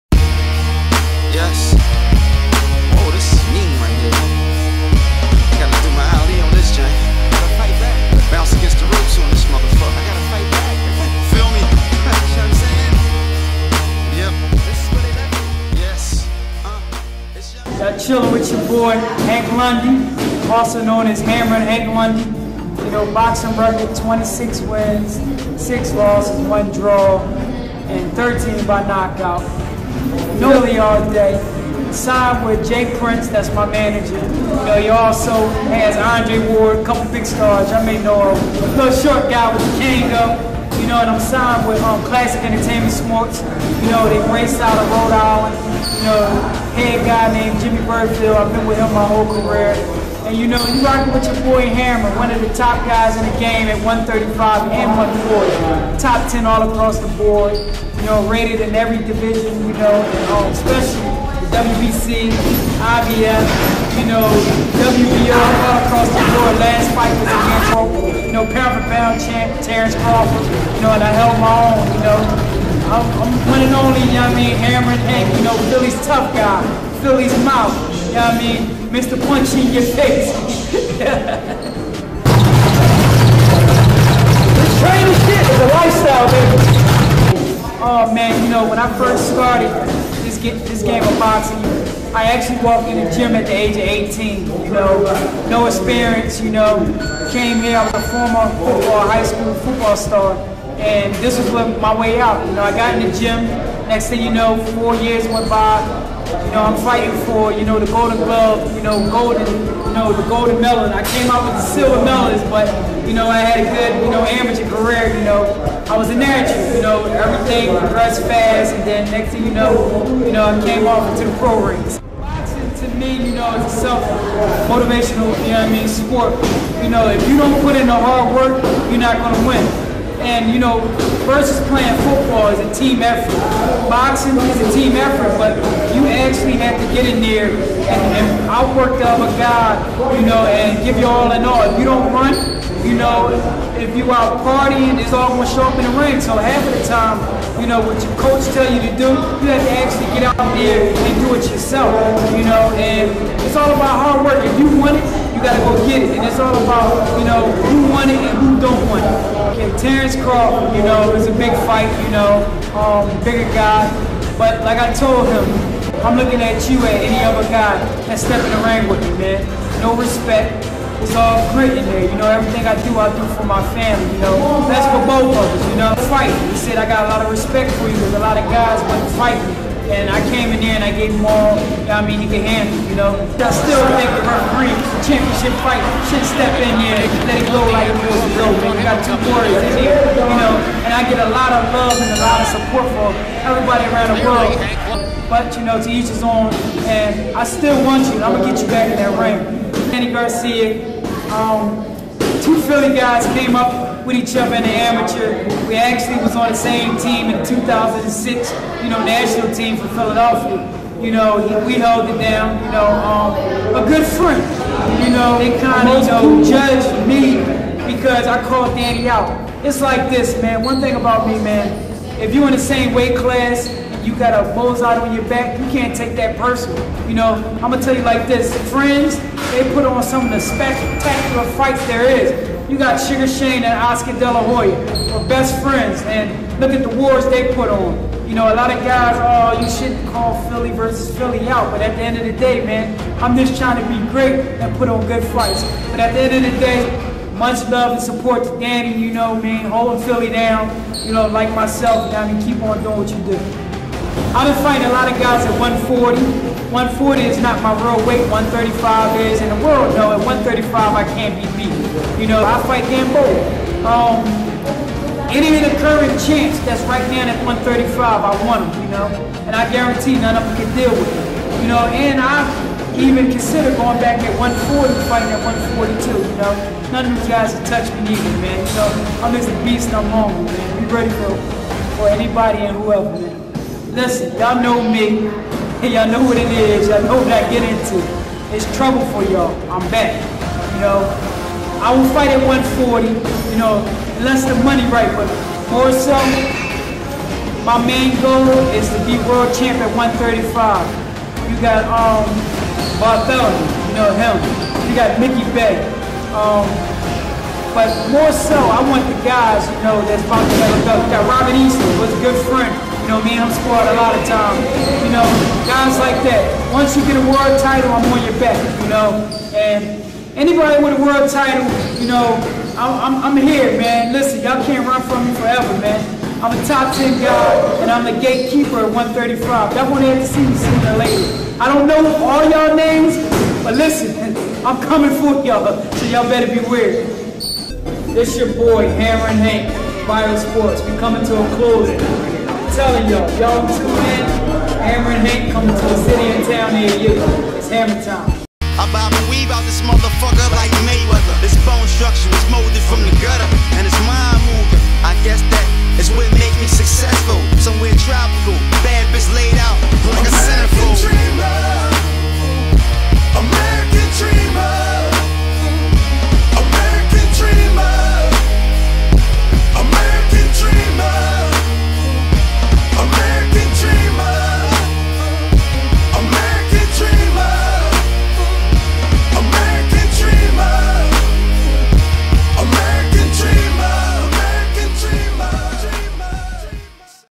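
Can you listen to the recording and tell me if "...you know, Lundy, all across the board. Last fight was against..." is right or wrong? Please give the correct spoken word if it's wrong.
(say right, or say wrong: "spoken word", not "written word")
wrong: "WBO", not "Lundy".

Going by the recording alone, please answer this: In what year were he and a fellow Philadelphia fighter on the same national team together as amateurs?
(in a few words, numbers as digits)
2006.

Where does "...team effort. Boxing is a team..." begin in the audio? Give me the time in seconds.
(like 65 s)
132 s.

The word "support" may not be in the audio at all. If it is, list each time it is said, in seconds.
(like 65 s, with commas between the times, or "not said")
192 s, 248 s.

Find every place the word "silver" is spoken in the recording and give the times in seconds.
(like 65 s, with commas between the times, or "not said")
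111 s.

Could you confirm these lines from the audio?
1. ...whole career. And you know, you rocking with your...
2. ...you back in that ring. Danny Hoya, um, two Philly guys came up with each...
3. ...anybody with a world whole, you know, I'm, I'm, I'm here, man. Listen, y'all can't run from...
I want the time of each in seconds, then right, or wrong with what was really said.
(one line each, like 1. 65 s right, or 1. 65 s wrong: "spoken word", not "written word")
1. 49 s right
2. 198 s wrong: "Garcia", not "Hoya"
3. 320 s wrong: "title", not "whole".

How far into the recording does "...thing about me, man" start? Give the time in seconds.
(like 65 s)
220 s.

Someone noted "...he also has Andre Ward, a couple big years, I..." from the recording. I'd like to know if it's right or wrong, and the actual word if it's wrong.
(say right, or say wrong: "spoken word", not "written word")
wrong: "stars", not "years".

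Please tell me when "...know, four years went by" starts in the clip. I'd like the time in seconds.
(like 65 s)
104 s.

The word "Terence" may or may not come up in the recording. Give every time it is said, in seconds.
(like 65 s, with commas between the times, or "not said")
69 s, 159 s.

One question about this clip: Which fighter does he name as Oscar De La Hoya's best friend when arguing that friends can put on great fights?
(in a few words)
Sugar Shane.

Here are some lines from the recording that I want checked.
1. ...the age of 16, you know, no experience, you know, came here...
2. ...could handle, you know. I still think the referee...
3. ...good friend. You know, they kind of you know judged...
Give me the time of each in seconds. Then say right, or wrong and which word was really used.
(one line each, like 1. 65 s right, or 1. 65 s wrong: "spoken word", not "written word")
1. 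93 s wrong: "18", not "16"
2. 182 s right
3. 213 s right.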